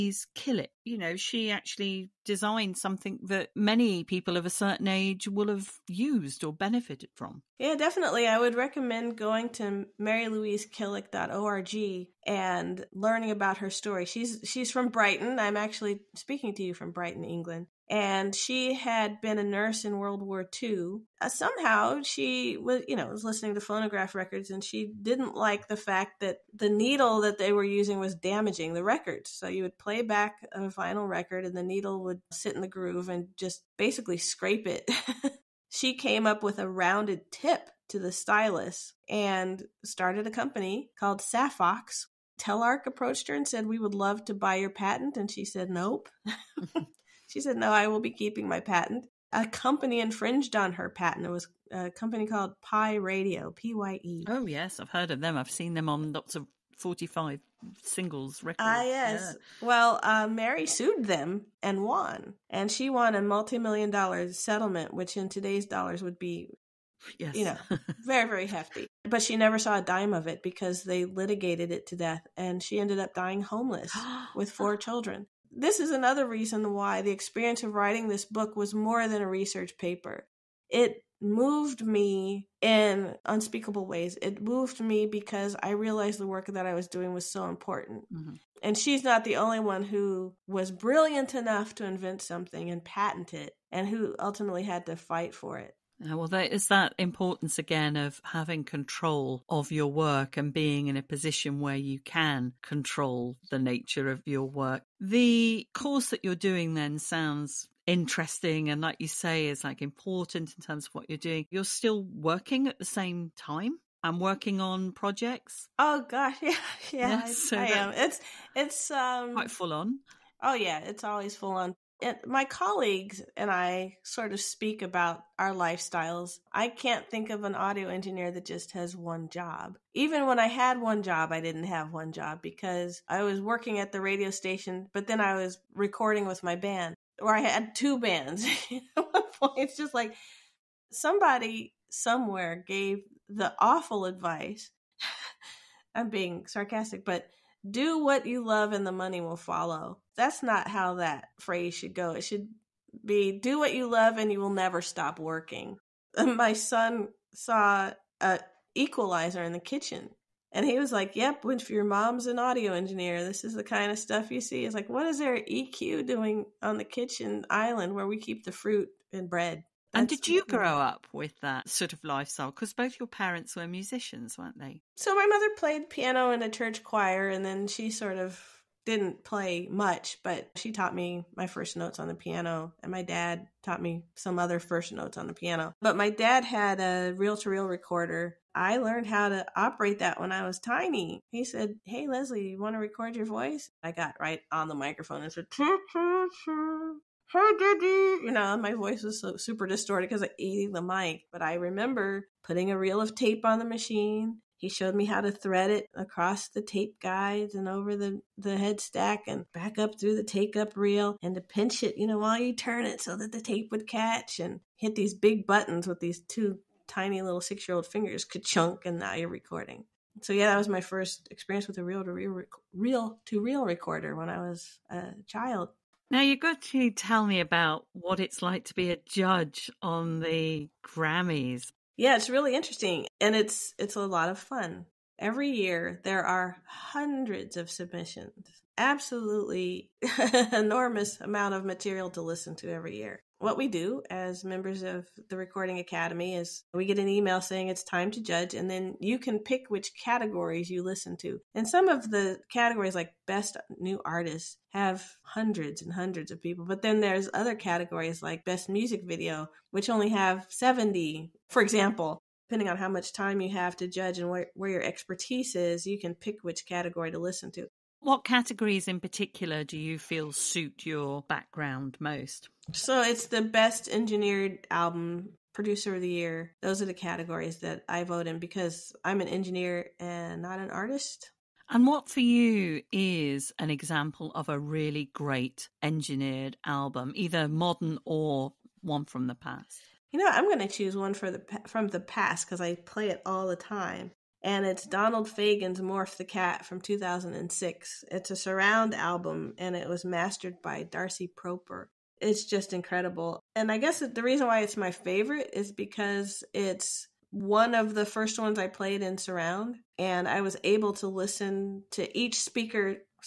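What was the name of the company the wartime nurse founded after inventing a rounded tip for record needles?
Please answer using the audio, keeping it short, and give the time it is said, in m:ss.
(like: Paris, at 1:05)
Safox, at 0:41.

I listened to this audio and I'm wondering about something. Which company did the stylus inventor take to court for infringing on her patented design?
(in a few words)
Pye Radio.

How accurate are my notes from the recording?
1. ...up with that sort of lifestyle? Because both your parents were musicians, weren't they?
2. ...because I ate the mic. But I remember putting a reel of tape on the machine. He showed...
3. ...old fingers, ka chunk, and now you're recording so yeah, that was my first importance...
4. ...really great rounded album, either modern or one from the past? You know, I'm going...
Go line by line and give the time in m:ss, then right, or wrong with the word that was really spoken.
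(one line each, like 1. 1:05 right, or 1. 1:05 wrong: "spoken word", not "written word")
1. 2:50 right
2. 3:20 right
3. 3:37 wrong: "experience", not "importance"
4. 4:44 wrong: "engineered", not "rounded".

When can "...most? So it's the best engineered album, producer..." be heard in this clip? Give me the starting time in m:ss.
4:31.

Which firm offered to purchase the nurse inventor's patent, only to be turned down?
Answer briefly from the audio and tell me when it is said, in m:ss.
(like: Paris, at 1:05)
Telarc, at 0:42.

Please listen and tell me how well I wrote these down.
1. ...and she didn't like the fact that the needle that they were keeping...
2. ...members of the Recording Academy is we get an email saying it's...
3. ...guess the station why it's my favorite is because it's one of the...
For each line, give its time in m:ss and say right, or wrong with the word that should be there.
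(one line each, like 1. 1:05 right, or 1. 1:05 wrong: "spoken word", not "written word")
1. 0:24 wrong: "using", not "keeping"
2. 4:04 right
3. 5:03 wrong: "reason", not "station".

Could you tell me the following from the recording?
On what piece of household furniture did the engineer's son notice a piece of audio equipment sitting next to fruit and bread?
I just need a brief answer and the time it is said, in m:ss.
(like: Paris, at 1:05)
kitchen island, at 2:46.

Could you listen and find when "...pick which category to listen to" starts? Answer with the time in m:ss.
4:26.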